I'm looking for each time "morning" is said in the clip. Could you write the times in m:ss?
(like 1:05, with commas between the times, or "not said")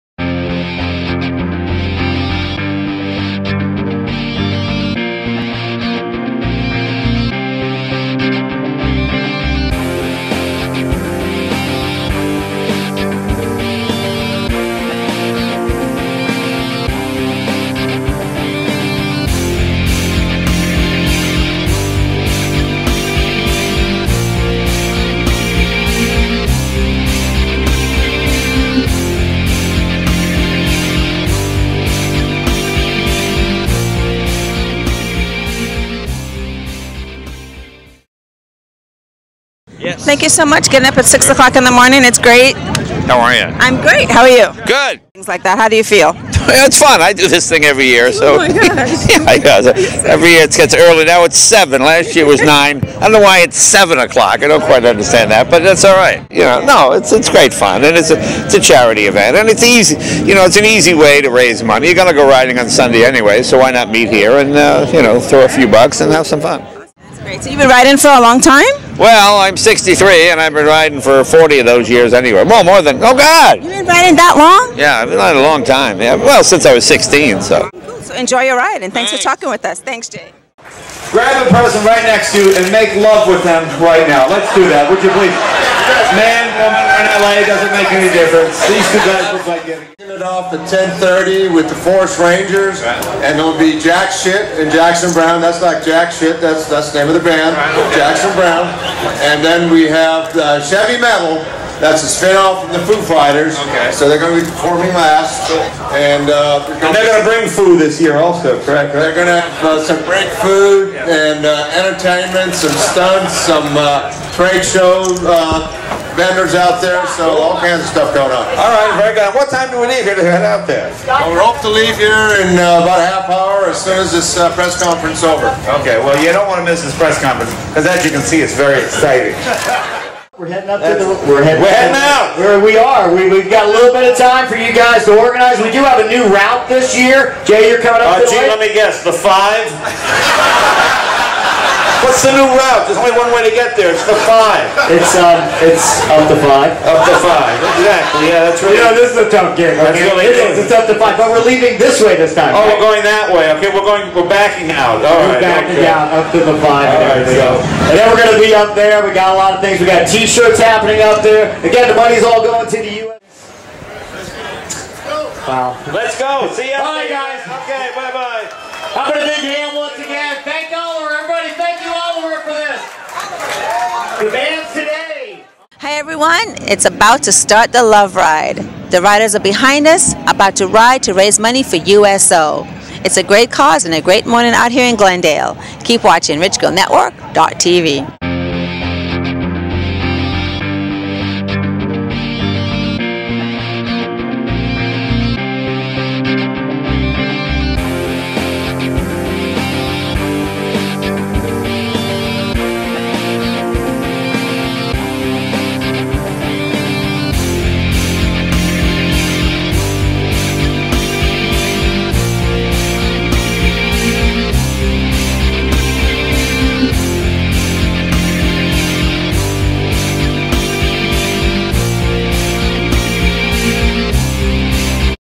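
0:41, 3:04.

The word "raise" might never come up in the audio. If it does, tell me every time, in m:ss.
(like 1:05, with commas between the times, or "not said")
1:01, 3:01.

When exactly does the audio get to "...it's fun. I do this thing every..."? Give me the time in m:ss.
0:46.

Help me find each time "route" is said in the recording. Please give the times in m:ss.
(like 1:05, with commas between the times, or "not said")
2:16, 2:22.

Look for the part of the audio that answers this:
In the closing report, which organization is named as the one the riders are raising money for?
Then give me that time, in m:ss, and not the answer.
3:01.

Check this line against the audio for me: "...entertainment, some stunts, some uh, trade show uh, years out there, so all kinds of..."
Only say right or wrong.
wrong.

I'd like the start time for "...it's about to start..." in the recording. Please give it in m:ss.
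2:56.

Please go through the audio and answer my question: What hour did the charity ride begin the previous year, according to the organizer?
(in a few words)
9.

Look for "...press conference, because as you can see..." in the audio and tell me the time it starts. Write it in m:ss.
2:06.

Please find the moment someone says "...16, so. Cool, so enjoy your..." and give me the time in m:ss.
1:16.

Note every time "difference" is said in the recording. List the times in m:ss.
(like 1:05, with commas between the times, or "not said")
1:28.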